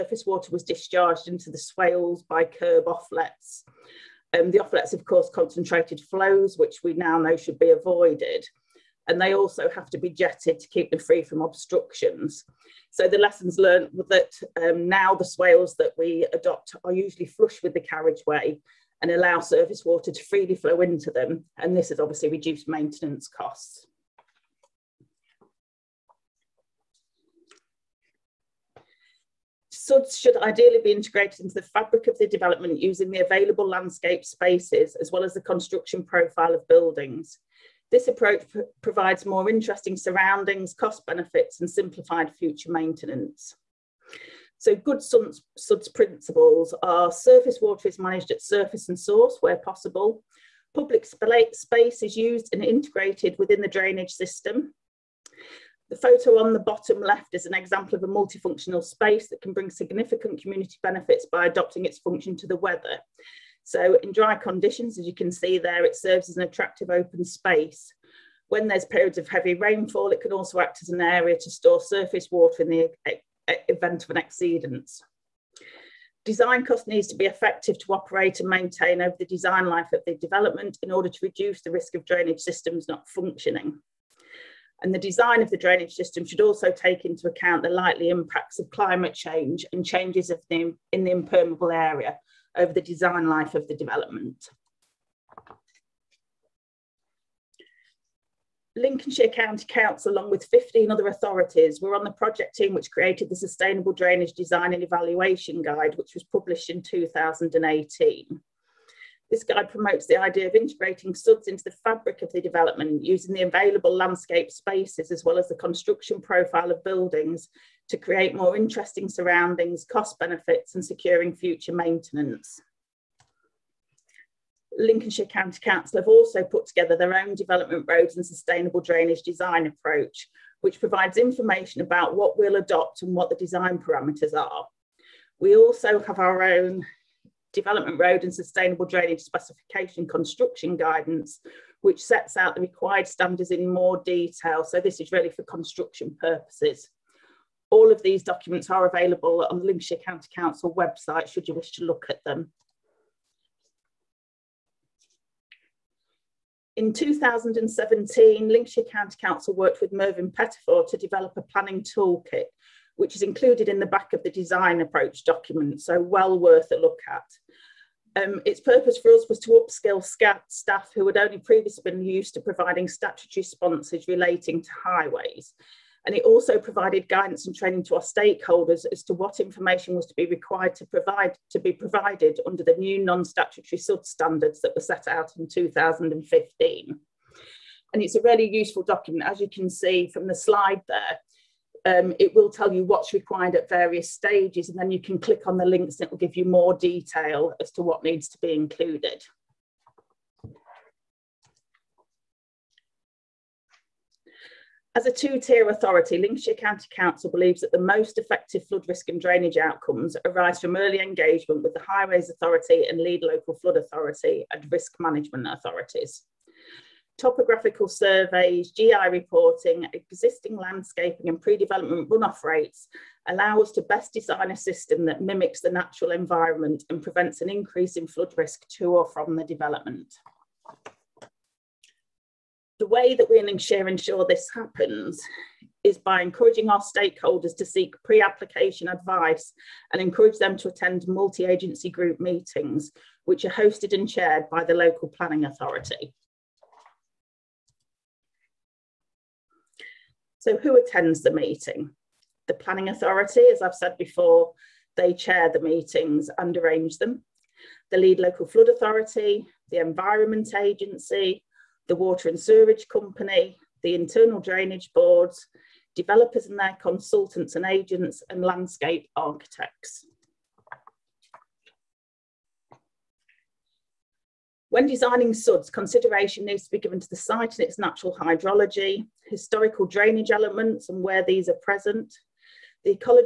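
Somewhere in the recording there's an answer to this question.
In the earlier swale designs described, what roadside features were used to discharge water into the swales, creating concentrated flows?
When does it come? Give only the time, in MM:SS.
00:02.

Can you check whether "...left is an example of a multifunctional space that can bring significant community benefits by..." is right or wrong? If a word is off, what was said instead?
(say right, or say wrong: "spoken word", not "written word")
right.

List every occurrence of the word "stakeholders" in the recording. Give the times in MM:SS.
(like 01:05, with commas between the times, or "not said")
02:58, 03:56.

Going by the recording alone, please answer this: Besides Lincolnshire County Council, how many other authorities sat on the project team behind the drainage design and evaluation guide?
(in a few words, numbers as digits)
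15.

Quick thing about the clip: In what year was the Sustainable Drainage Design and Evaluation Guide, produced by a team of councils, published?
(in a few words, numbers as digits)
2018.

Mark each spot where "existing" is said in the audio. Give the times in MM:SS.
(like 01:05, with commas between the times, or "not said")
03:39.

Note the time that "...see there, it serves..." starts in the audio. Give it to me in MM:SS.
01:05.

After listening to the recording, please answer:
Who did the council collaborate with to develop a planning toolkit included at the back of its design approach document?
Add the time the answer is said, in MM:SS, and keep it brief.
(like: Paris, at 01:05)
Mervyn Pettifor, at 02:39.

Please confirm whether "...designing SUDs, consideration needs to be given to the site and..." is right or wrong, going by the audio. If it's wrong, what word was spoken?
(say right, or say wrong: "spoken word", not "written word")
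right.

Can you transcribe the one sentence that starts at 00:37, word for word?
This approach provides more interesting surroundings, cost benefits and simplified future maintenance.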